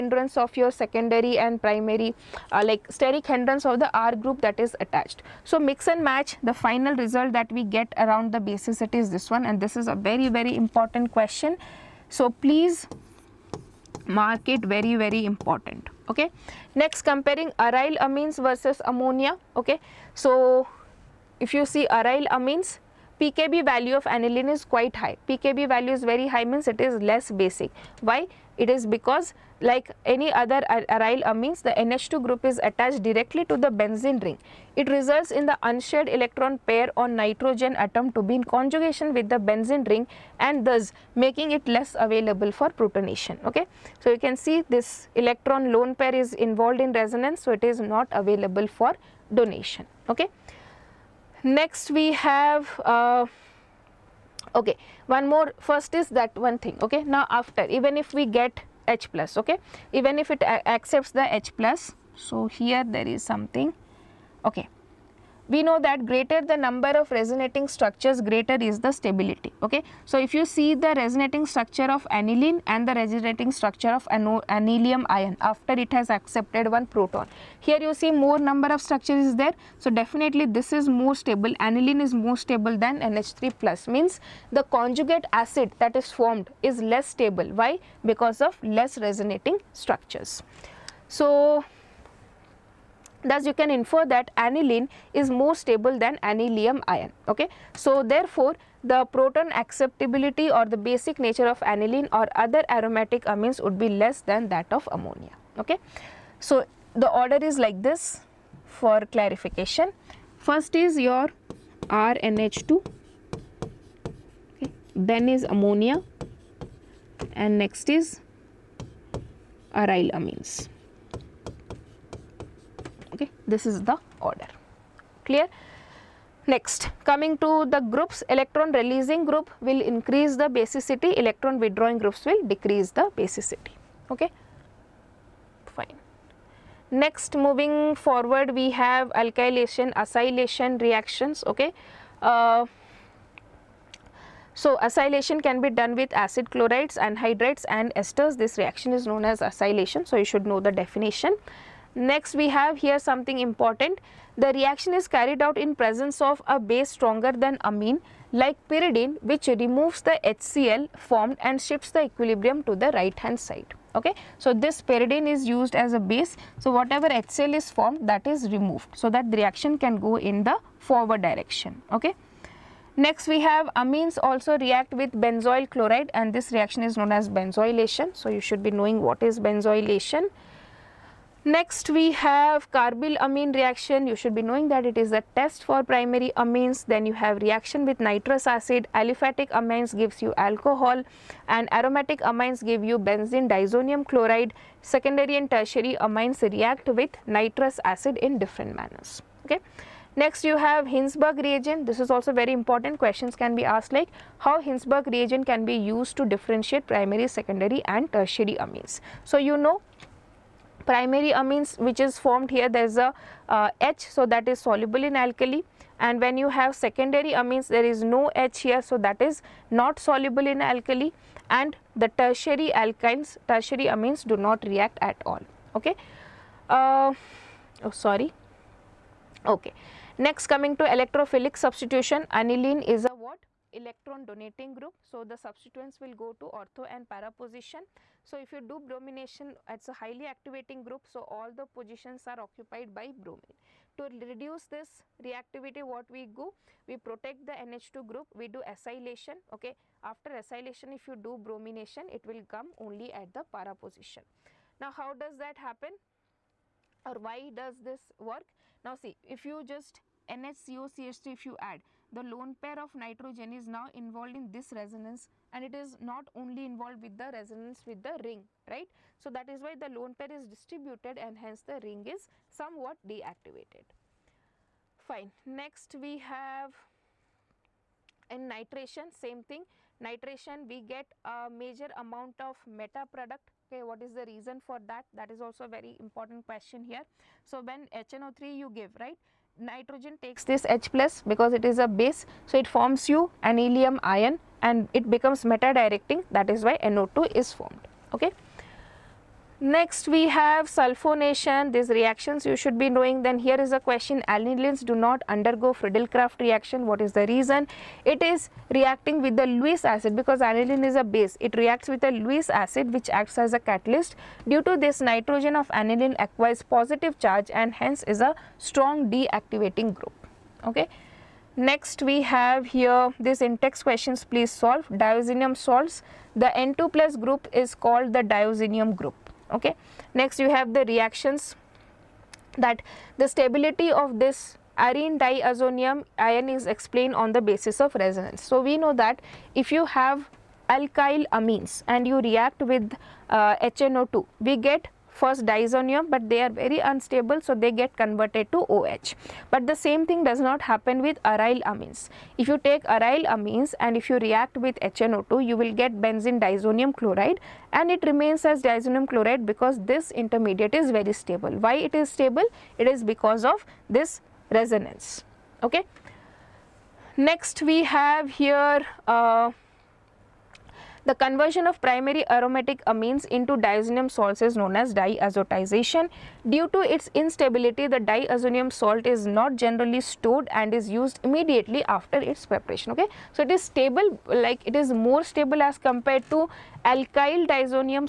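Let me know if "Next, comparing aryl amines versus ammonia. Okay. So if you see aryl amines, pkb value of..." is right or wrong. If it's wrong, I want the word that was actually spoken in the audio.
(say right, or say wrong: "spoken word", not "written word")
right.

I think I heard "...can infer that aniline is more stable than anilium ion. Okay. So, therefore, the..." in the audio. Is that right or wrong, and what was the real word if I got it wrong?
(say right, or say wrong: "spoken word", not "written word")
right.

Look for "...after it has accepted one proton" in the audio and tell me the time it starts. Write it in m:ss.
1:15.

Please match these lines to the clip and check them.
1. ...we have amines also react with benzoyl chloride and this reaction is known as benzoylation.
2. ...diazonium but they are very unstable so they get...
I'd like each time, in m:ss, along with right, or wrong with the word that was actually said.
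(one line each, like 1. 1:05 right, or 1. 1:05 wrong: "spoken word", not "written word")
1. 2:53 right
2. 5:45 right.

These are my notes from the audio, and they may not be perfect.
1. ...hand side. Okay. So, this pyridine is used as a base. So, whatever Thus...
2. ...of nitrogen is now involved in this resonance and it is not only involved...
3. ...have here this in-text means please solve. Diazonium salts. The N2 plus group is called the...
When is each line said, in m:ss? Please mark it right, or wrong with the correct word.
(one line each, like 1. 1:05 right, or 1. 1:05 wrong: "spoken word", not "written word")
1. 2:43 wrong: "HCl", not "Thus"
2. 4:22 right
3. 5:22 wrong: "questions", not "means".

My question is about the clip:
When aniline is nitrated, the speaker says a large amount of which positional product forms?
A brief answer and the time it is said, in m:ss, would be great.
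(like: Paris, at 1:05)
Meta product, at 4:42.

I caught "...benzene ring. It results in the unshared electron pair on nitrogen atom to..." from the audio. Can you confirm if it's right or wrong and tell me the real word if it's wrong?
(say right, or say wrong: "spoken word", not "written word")
right.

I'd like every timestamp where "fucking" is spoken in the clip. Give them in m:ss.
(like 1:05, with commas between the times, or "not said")
not said.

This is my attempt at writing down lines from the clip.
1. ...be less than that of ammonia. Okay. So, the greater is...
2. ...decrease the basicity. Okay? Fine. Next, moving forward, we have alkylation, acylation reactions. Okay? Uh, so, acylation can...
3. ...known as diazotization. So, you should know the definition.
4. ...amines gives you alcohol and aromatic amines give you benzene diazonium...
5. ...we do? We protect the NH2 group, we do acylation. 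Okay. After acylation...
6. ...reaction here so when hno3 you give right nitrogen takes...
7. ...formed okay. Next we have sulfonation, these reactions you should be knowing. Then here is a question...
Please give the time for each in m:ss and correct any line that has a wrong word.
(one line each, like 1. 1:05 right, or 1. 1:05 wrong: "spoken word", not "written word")
1. 1:43 wrong: "order", not "greater"
2. 2:12 right
3. 2:29 wrong: "acylation", not "diazotization"
4. 3:09 right
5. 4:06 right
6. 4:46 wrong: "question", not "reaction"
7. 4:57 right.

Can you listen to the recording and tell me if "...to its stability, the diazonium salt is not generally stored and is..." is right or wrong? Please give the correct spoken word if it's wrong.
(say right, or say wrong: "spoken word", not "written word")
wrong: "instability", not "stability".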